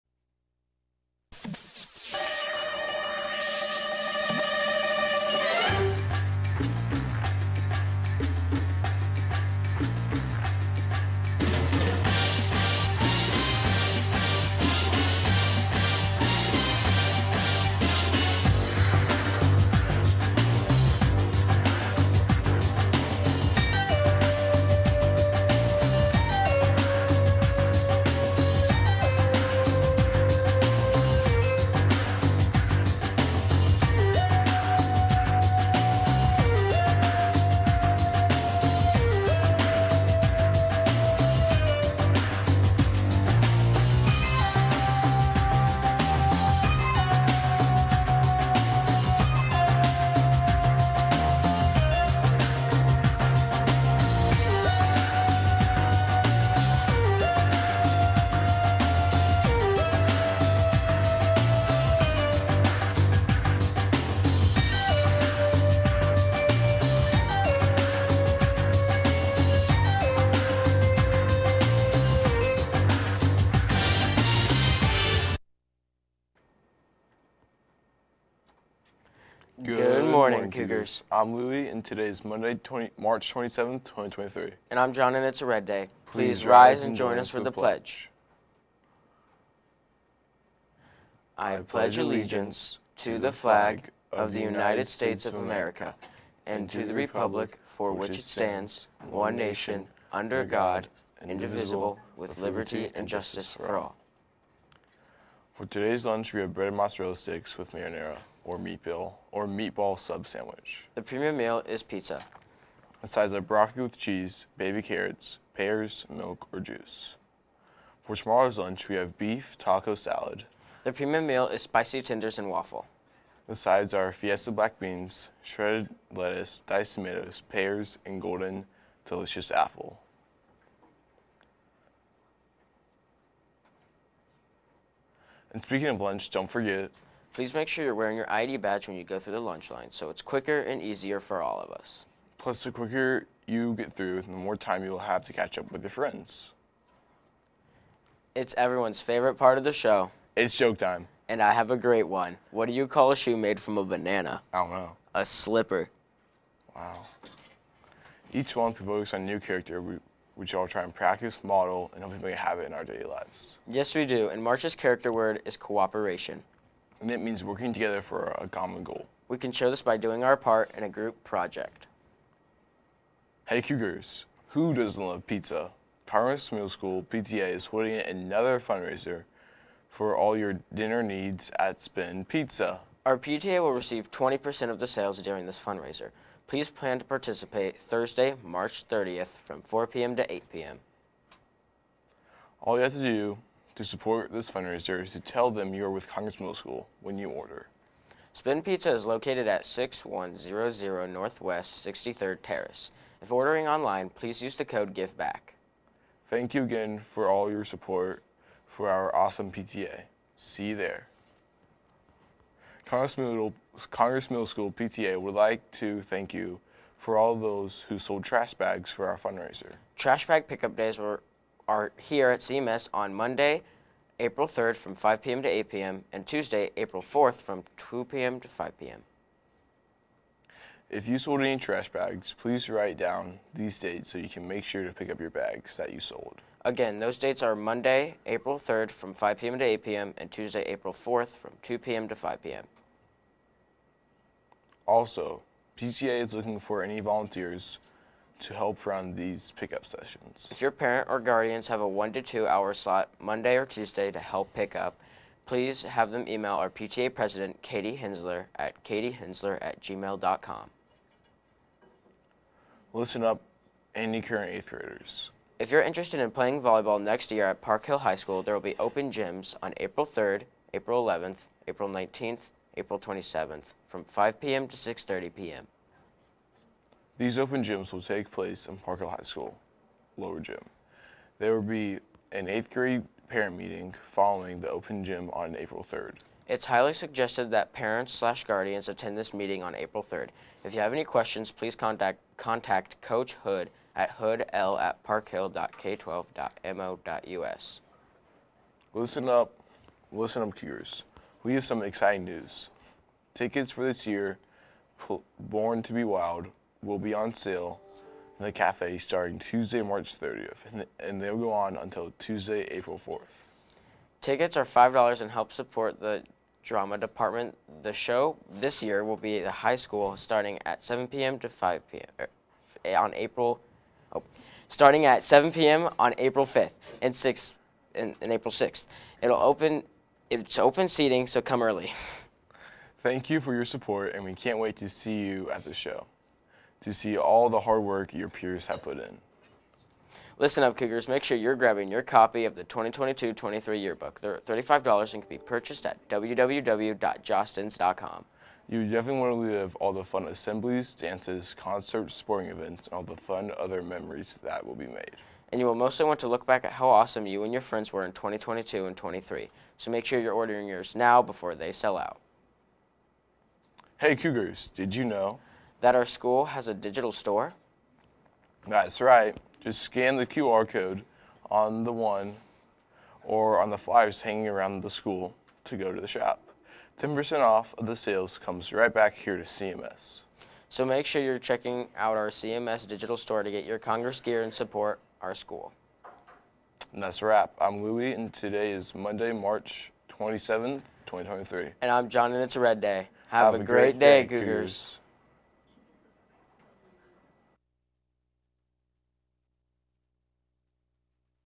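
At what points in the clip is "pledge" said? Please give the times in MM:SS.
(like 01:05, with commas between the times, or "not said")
01:27, 01:31.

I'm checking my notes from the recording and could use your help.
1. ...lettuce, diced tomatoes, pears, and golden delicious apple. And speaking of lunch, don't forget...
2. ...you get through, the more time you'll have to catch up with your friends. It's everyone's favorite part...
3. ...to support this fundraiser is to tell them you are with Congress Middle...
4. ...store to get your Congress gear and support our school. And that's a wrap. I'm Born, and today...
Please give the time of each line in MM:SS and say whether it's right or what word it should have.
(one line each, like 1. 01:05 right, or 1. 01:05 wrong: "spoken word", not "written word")
1. 02:06 right
2. 02:23 right
3. 03:13 right
4. 06:23 wrong: "Louie", not "Born".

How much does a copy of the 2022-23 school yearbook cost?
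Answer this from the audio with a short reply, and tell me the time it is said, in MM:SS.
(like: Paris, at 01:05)
$35, at 05:44.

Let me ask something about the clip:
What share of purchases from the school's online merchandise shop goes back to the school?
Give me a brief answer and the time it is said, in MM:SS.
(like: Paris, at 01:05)
10%, at 06:16.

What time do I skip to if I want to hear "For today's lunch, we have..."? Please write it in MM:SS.
01:45.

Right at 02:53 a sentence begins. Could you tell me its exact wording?
Hey Cougars, who doesn't love pizza?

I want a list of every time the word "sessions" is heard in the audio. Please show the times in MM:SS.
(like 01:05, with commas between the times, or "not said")
04:09.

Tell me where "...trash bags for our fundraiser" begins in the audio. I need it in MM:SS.
03:38.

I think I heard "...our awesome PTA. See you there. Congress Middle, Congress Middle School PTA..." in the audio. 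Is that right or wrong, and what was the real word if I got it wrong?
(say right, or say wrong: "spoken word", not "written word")
right.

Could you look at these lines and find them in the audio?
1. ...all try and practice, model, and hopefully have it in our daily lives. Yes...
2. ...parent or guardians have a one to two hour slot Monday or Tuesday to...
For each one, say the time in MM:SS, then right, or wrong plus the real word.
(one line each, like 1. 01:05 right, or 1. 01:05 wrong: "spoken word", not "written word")
1. 02:40 right
2. 04:10 right.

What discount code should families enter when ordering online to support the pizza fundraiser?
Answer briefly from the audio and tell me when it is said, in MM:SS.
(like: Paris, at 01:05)
GIVEBACK, at 03:24.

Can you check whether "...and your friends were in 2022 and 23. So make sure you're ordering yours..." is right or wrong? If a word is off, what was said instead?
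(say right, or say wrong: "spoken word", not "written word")
right.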